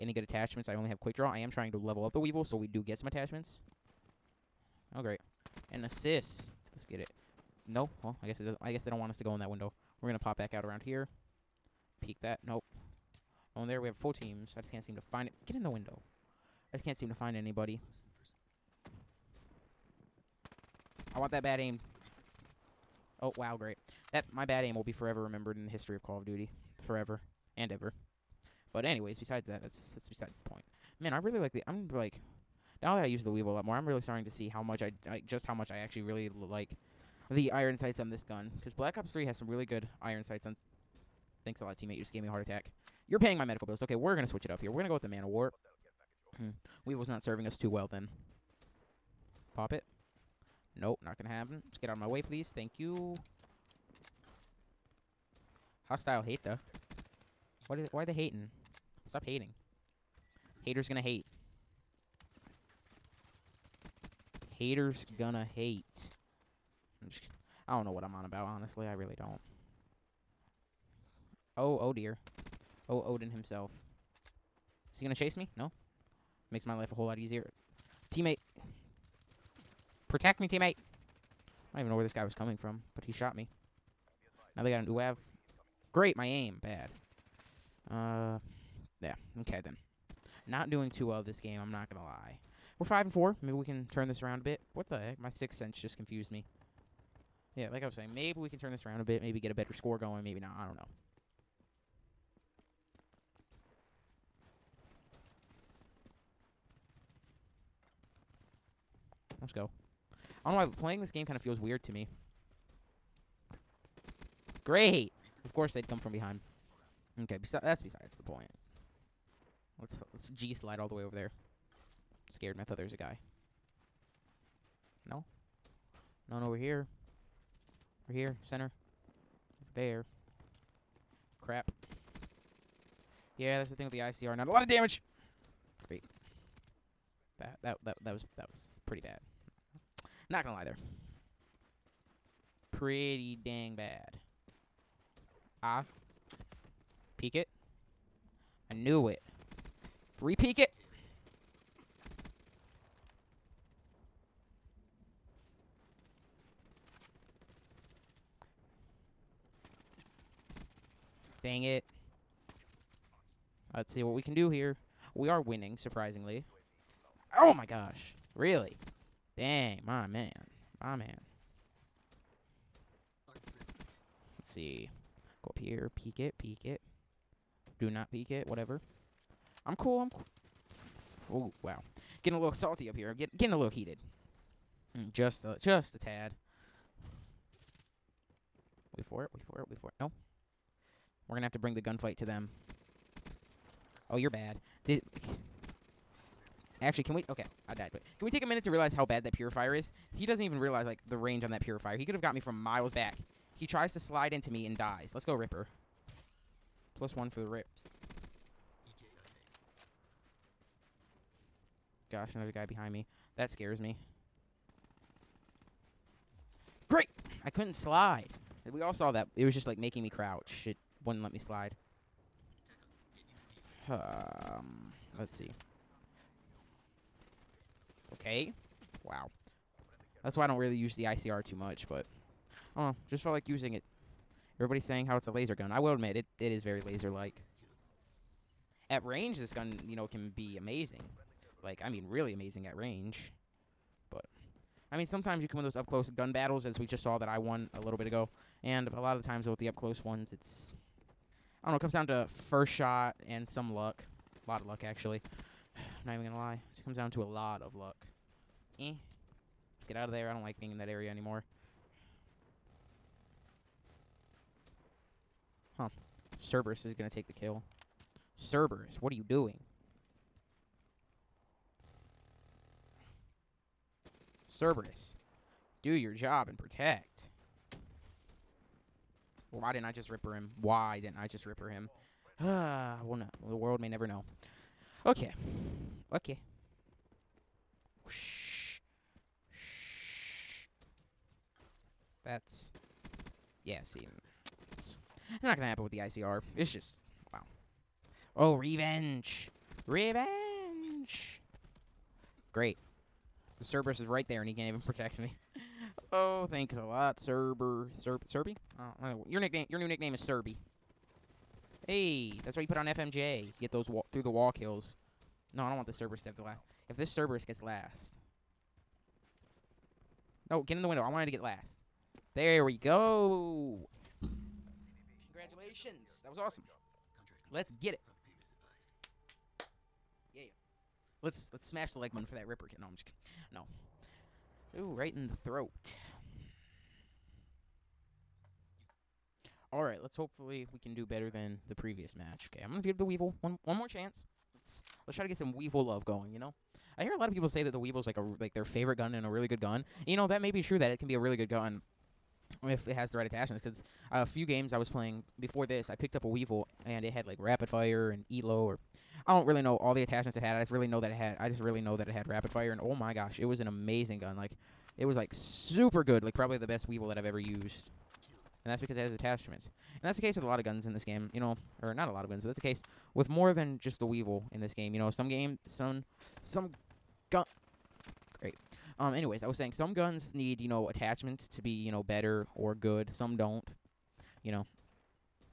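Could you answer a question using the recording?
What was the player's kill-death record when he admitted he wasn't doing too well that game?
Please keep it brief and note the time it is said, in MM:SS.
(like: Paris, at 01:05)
5 and 4, at 01:32.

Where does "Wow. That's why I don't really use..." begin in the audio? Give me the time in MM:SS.
03:49.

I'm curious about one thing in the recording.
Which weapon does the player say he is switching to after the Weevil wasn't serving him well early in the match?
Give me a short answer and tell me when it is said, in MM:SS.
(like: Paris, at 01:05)
Man of War, at 00:45.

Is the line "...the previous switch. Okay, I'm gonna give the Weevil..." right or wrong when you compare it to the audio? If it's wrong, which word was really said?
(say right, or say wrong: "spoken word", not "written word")
wrong: "match", not "switch".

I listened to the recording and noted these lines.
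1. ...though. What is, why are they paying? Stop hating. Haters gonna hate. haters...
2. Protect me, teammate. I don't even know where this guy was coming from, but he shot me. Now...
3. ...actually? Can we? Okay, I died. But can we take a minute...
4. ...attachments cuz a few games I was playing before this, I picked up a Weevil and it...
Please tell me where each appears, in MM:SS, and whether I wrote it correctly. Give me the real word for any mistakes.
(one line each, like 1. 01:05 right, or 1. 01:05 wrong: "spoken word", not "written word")
1. 00:56 wrong: "hating", not "paying"
2. 01:20 right
3. 03:16 right
4. 05:53 right.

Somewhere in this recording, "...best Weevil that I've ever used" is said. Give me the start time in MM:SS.
06:06.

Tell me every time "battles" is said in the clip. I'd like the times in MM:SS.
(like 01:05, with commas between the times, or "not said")
04:06.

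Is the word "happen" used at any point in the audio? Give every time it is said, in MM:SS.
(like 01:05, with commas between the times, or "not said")
00:51, 04:55.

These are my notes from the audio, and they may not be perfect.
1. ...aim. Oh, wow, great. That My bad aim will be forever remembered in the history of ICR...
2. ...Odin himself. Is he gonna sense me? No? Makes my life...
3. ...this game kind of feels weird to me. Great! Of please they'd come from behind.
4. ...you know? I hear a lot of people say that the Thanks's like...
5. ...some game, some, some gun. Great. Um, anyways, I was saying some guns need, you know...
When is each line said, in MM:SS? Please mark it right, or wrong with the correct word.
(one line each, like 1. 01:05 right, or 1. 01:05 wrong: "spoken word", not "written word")
1. 00:21 wrong: "Call", not "ICR"
2. 01:13 wrong: "chase", not "sense"
3. 01:50 wrong: "course", not "please"
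4. 05:46 wrong: "Weevil", not "Thanks"
5. 06:15 right.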